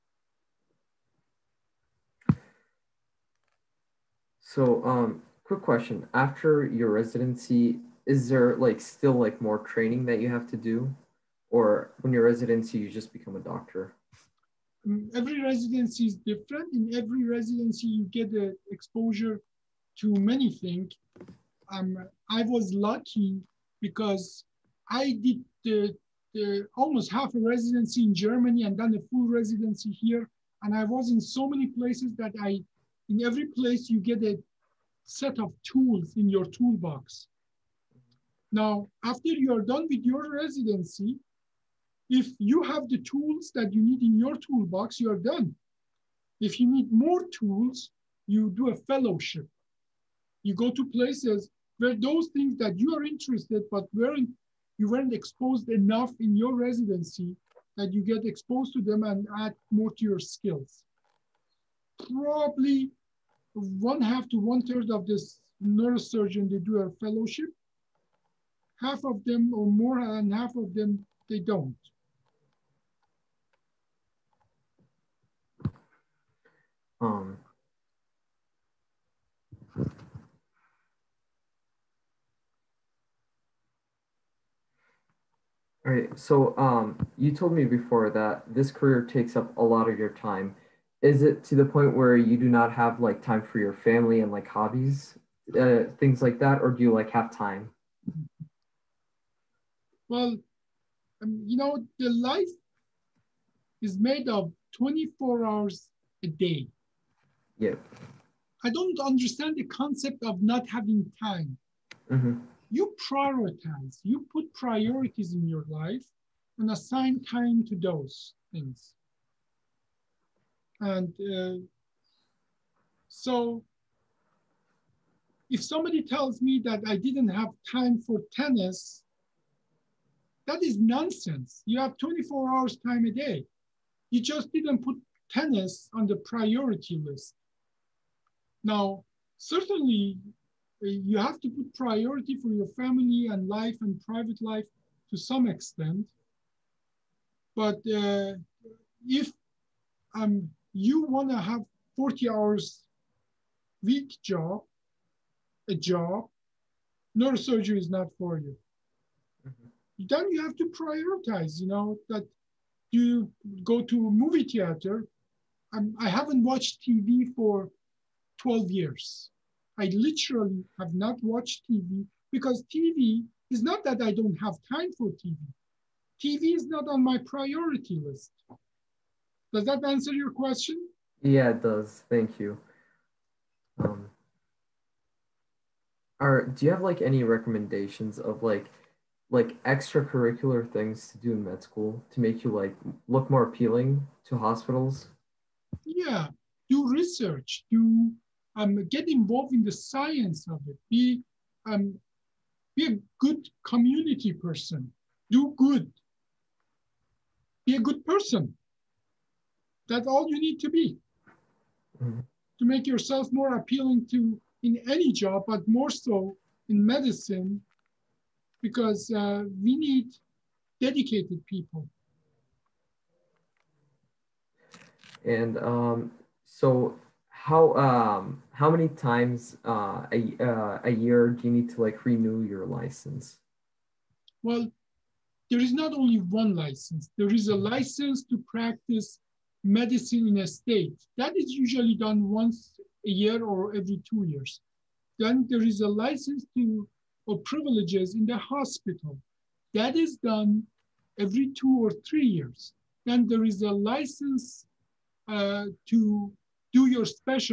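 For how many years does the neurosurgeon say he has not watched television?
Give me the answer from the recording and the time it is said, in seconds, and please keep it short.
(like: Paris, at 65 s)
12, at 168 s.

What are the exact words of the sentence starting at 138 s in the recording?
Now, certainly uh, you have to put priority for your family and life and private life to some extent.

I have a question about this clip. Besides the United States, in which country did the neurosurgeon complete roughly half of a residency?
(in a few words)
Germany.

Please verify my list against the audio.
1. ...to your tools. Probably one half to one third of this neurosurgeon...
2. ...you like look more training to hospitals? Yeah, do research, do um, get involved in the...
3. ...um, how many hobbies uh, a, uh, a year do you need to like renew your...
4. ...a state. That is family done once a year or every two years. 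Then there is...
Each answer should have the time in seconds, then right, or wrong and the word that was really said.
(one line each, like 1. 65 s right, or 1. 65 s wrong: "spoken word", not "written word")
1. 59 s wrong: "skills", not "tools"
2. 192 s wrong: "appealing", not "training"
3. 227 s wrong: "times", not "hobbies"
4. 240 s wrong: "usually", not "family".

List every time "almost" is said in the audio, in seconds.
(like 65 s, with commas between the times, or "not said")
26 s.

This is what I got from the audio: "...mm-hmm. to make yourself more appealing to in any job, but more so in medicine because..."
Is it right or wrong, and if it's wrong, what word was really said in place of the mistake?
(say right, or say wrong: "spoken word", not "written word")
right.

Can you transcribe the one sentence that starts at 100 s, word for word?
Well, um, you know, the life is made of 24 hours a day.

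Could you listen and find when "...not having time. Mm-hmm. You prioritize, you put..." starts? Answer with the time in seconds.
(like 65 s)
110 s.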